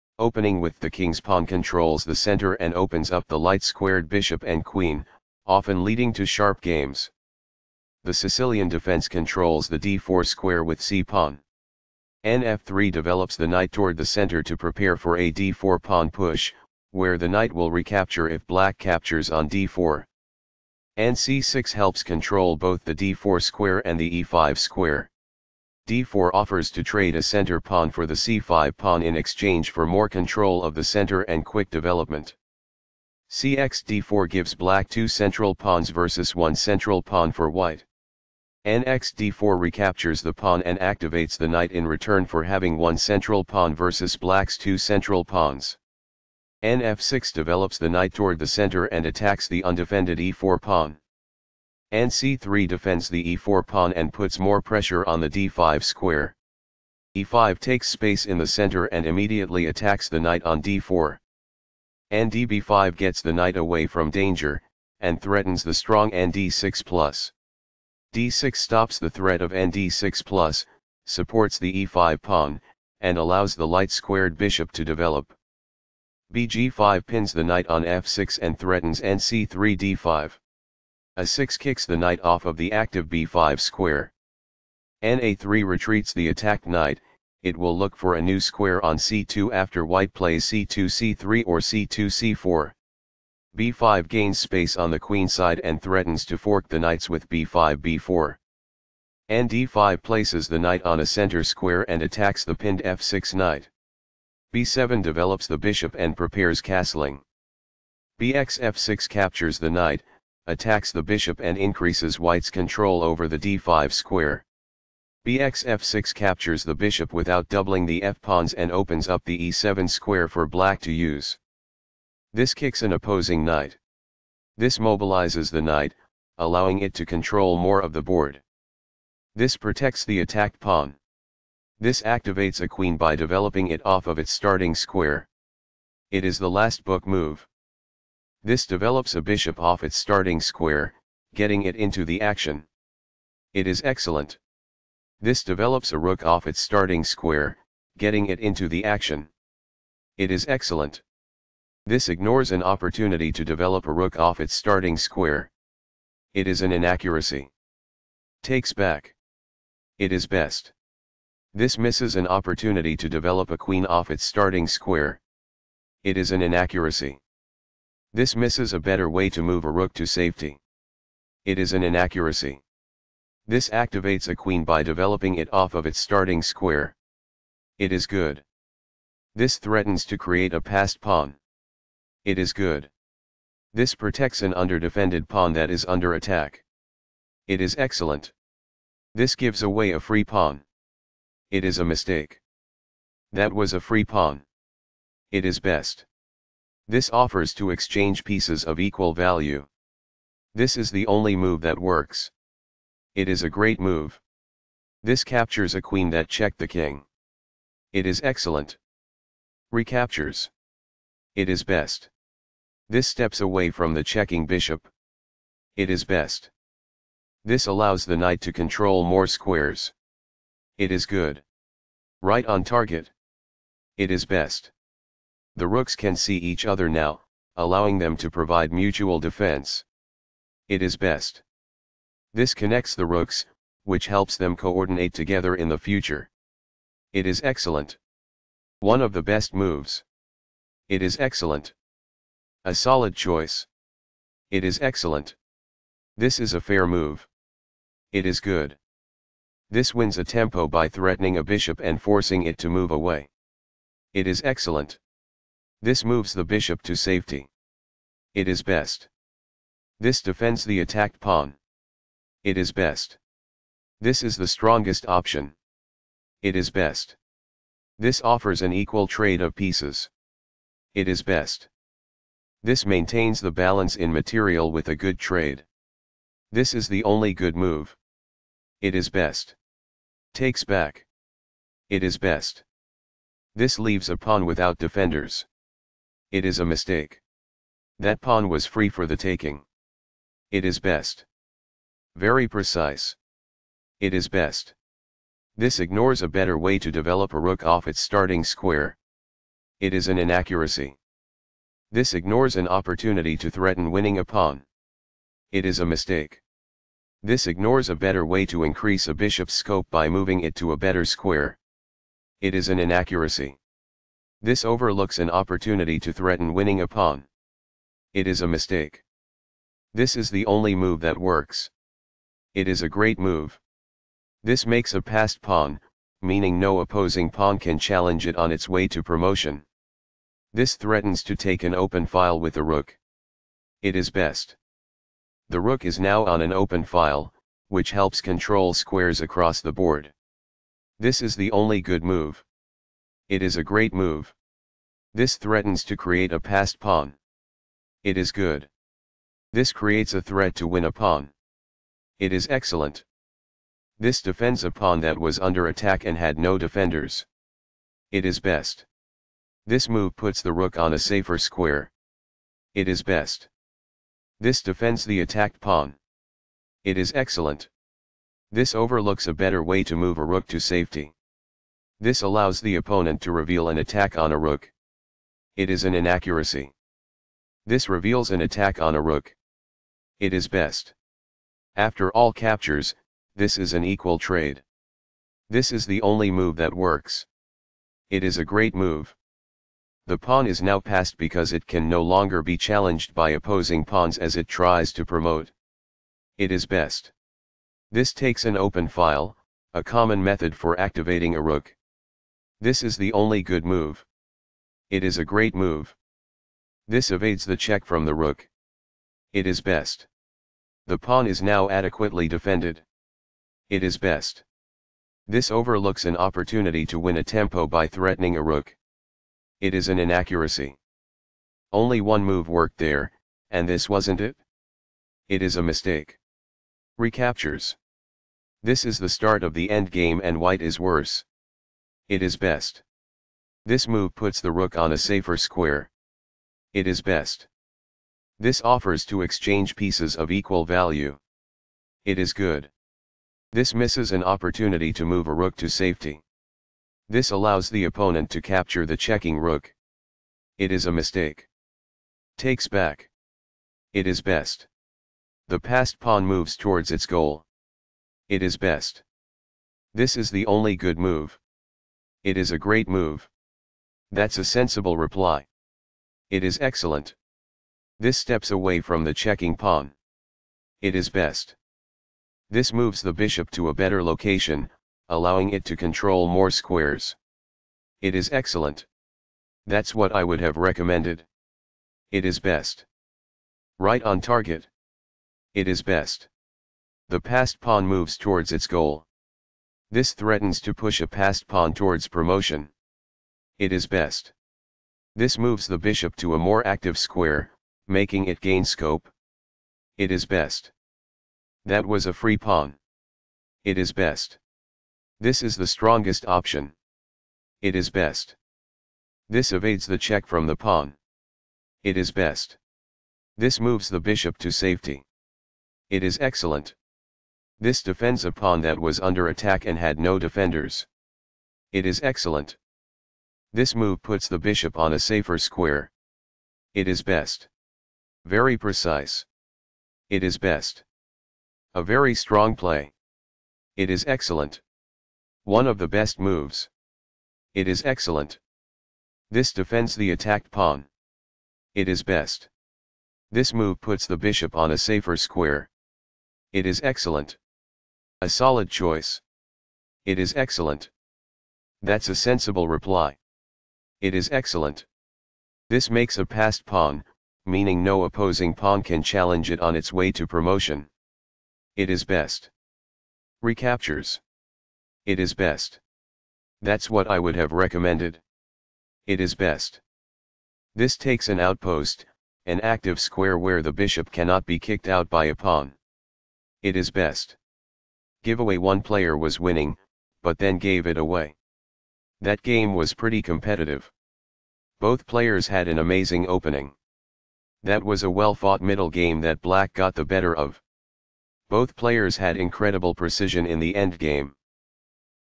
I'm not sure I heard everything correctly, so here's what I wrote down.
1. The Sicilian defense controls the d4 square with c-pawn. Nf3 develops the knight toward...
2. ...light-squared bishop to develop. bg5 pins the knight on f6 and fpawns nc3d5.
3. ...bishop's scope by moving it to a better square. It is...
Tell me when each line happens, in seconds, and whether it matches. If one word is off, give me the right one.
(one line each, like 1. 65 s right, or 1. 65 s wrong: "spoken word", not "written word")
1. 8 s right
2. 73 s wrong: "threatens", not "fpawns"
3. 309 s right.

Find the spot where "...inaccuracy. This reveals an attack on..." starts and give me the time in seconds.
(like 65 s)
375 s.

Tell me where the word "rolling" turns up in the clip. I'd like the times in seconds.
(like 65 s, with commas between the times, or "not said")
not said.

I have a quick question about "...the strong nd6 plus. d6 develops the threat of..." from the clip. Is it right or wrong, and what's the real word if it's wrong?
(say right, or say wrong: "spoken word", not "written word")
wrong: "stops", not "develops".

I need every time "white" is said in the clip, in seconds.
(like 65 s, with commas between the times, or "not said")
37 s, 89 s, 112 s, 430 s.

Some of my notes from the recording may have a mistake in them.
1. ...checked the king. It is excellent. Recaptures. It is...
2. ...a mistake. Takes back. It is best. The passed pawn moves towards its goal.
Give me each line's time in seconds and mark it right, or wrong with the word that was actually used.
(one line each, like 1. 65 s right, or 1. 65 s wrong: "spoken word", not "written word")
1. 206 s right
2. 450 s right.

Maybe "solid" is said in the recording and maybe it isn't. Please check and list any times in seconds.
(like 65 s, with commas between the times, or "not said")
242 s, 548 s.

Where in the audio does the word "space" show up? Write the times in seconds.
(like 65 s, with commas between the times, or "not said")
57 s, 94 s.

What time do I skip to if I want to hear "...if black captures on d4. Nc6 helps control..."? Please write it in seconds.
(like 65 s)
18 s.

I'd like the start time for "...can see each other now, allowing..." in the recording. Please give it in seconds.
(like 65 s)
225 s.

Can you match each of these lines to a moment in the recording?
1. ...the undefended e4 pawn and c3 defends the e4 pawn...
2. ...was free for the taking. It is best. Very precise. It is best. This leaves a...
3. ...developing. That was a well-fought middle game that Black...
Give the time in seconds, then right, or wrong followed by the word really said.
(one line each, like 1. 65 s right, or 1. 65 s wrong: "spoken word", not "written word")
1. 49 s right
2. 288 s wrong: "ignores", not "leaves"
3. 586 s wrong: "opening", not "developing".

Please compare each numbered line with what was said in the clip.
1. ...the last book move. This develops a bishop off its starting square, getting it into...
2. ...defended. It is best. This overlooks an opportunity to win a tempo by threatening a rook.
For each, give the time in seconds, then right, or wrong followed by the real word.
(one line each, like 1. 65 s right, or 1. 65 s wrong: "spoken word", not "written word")
1. 136 s right
2. 412 s right.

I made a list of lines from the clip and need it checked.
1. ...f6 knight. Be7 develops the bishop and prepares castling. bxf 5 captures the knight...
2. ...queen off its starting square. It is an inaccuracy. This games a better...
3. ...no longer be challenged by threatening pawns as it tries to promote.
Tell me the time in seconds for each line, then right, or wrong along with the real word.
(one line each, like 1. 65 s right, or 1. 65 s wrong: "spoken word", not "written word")
1. 102 s wrong: "6", not "5"
2. 163 s wrong: "misses", not "games"
3. 391 s wrong: "opposing", not "threatening".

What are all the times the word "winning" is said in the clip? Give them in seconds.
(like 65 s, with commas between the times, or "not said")
303 s, 316 s, 579 s.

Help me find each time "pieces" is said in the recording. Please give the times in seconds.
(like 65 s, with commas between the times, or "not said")
198 s, 269 s, 439 s.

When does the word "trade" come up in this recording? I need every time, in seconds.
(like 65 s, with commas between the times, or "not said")
26 s, 269 s, 275 s, 384 s.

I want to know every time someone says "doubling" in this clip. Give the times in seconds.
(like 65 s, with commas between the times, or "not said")
117 s.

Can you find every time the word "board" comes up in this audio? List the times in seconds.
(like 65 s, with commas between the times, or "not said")
128 s, 339 s.